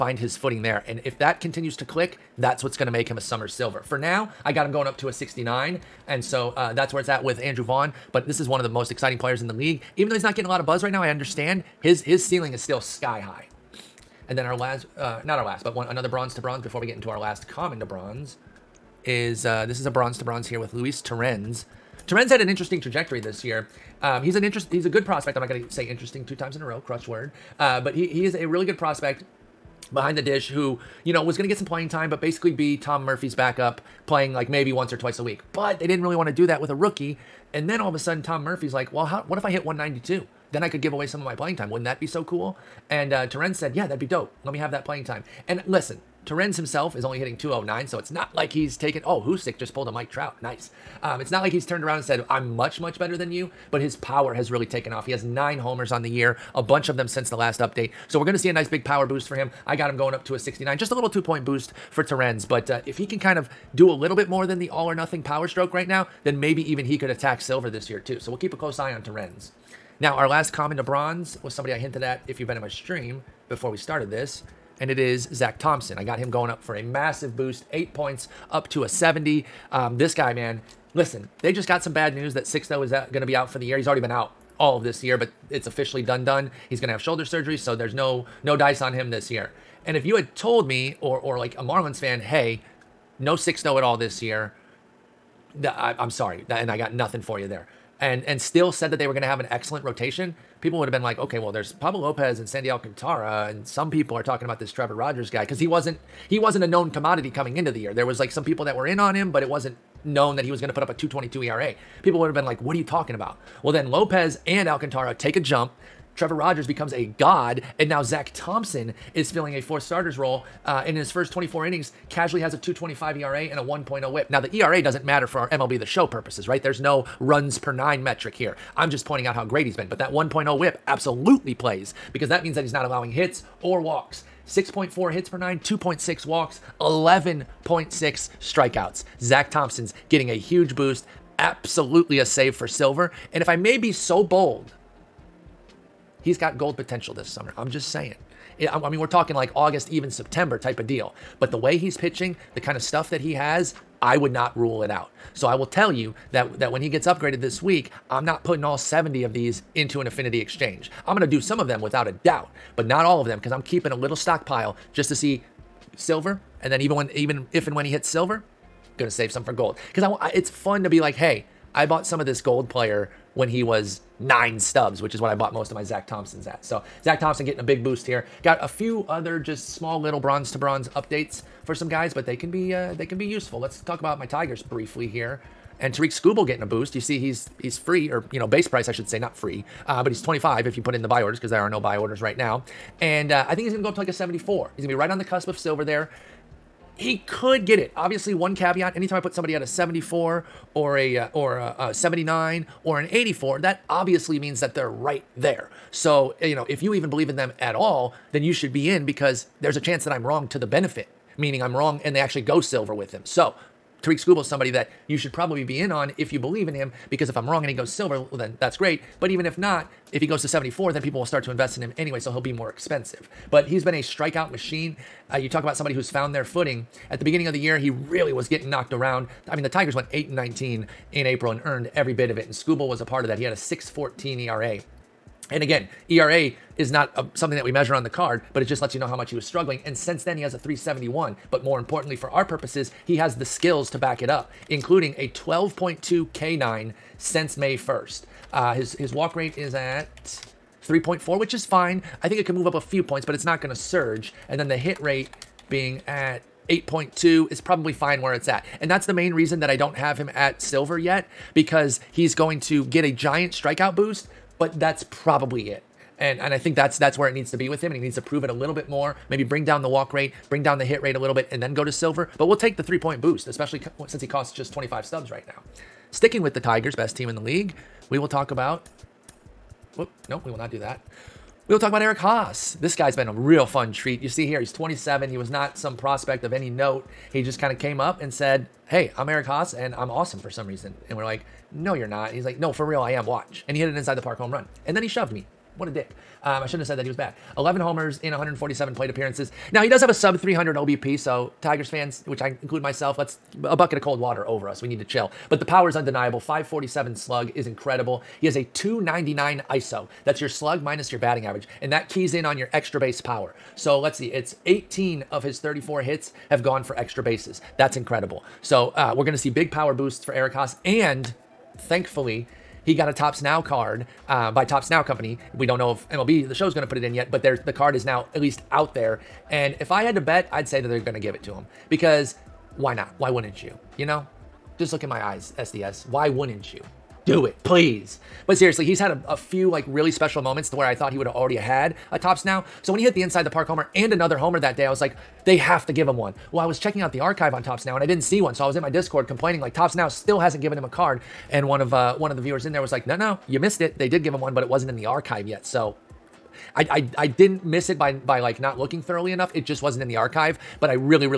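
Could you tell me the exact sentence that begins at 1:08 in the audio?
So we'll keep a close eye on Torrens.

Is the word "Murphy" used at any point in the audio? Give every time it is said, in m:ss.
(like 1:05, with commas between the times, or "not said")
0:33, 0:38.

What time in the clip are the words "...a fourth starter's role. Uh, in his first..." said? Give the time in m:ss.
1:59.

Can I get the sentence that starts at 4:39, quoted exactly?
Whoop, nope, we will not do that.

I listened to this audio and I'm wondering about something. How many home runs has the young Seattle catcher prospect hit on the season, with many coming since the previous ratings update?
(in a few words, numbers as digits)
9.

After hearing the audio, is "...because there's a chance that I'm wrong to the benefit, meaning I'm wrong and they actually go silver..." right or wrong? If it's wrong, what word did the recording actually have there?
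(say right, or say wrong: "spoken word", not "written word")
right.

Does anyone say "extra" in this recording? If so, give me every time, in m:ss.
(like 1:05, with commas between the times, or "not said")
5:12, 5:16.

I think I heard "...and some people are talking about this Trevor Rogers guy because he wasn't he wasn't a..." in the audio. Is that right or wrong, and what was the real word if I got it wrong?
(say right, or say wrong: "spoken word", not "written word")
right.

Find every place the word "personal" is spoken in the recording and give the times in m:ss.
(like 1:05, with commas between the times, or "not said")
not said.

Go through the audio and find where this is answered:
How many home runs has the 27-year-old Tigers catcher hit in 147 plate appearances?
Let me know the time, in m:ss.
4:57.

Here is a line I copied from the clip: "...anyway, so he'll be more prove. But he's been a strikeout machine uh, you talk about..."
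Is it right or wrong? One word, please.
wrong.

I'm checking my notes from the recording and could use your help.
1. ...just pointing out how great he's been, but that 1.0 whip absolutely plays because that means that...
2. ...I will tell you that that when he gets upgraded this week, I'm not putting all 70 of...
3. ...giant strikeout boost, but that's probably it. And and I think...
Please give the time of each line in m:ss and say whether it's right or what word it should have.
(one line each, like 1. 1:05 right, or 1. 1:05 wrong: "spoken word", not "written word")
1. 2:08 right
2. 2:35 right
3. 4:23 right.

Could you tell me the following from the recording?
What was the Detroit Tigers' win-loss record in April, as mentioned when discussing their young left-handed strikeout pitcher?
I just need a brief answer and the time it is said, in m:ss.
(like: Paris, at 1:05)
8 and 19, at 3:50.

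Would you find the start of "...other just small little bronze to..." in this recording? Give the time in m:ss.
2:59.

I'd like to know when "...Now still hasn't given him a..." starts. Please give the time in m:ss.
5:49.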